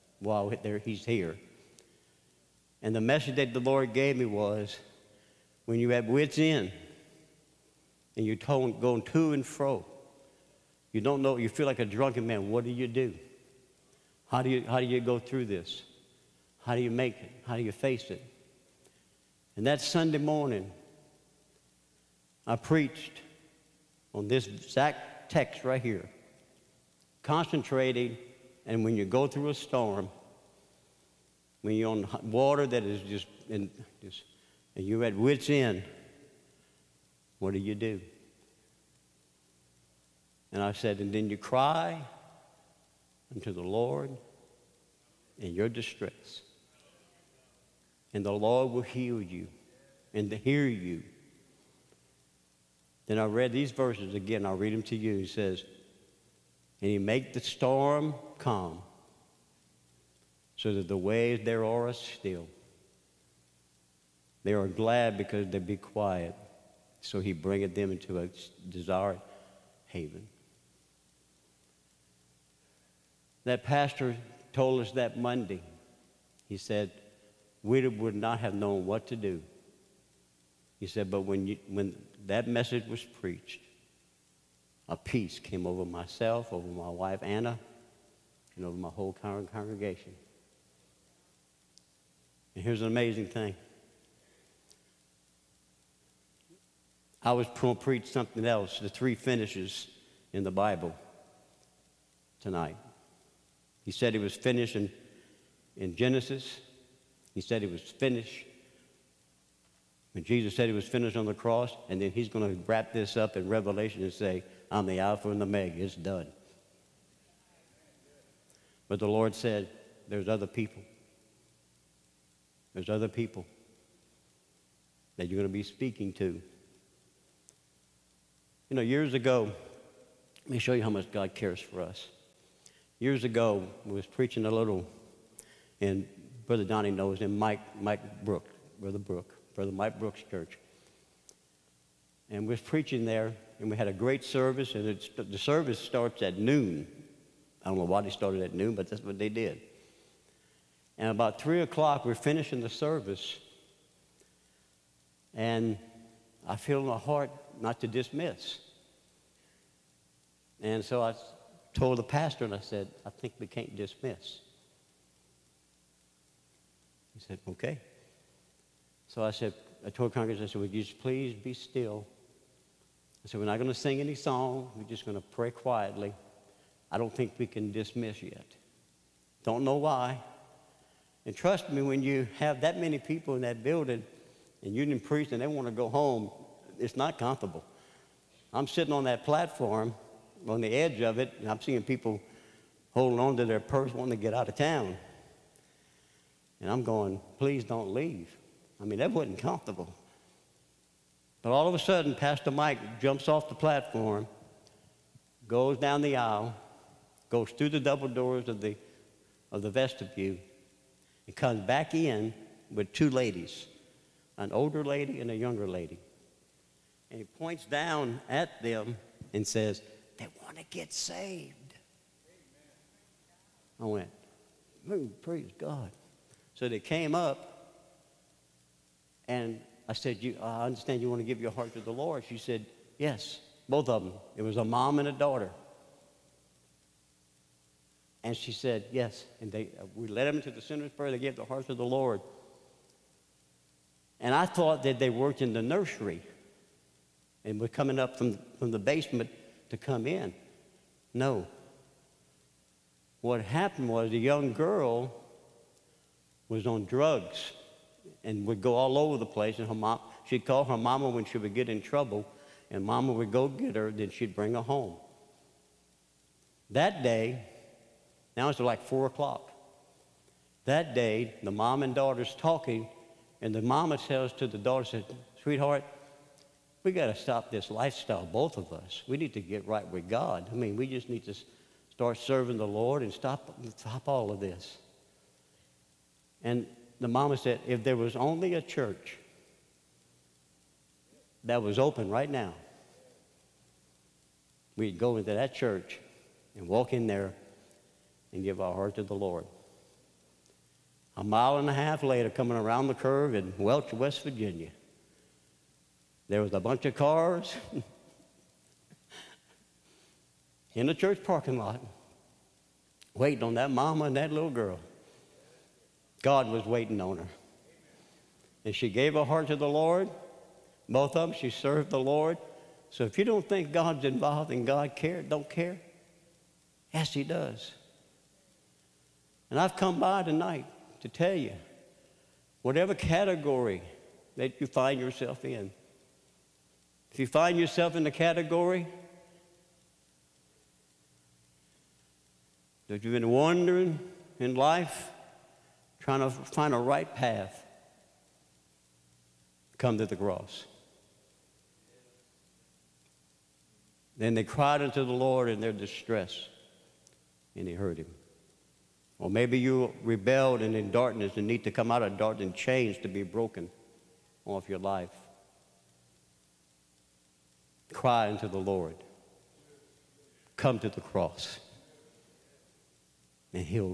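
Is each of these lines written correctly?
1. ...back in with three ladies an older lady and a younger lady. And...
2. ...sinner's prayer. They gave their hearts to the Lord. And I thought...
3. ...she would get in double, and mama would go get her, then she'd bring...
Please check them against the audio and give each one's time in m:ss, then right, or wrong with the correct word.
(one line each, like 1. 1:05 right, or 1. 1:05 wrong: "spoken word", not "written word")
1. 3:31 wrong: "two", not "three"
2. 4:00 right
3. 4:21 wrong: "trouble", not "double".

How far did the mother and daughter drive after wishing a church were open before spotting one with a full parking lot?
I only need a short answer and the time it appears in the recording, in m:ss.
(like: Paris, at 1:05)
A mile and a half, at 5:01.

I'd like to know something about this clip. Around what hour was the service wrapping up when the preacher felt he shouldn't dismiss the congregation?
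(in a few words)
3 o'clock.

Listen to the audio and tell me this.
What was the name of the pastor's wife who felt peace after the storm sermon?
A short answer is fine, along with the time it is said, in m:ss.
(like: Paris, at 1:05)
Anna, at 1:27.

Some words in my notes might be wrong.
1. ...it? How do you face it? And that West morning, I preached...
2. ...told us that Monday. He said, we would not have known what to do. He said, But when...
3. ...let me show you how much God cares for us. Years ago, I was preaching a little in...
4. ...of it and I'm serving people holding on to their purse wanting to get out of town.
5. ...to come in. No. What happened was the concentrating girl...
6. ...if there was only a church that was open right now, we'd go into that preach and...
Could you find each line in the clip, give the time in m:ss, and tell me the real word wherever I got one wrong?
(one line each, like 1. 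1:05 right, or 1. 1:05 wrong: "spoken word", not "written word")
1. 0:17 wrong: "Sunday", not "West"
2. 1:14 right
3. 2:10 right
4. 3:10 wrong: "seeing", not "serving"
5. 4:09 wrong: "young", not "concentrating"
6. 4:47 wrong: "church", not "preach".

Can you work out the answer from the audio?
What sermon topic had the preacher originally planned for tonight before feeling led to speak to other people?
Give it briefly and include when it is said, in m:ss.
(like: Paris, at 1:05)
The three finishes in the Bible, at 1:38.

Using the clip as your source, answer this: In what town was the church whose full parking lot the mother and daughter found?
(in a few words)
Welch, West Virginia.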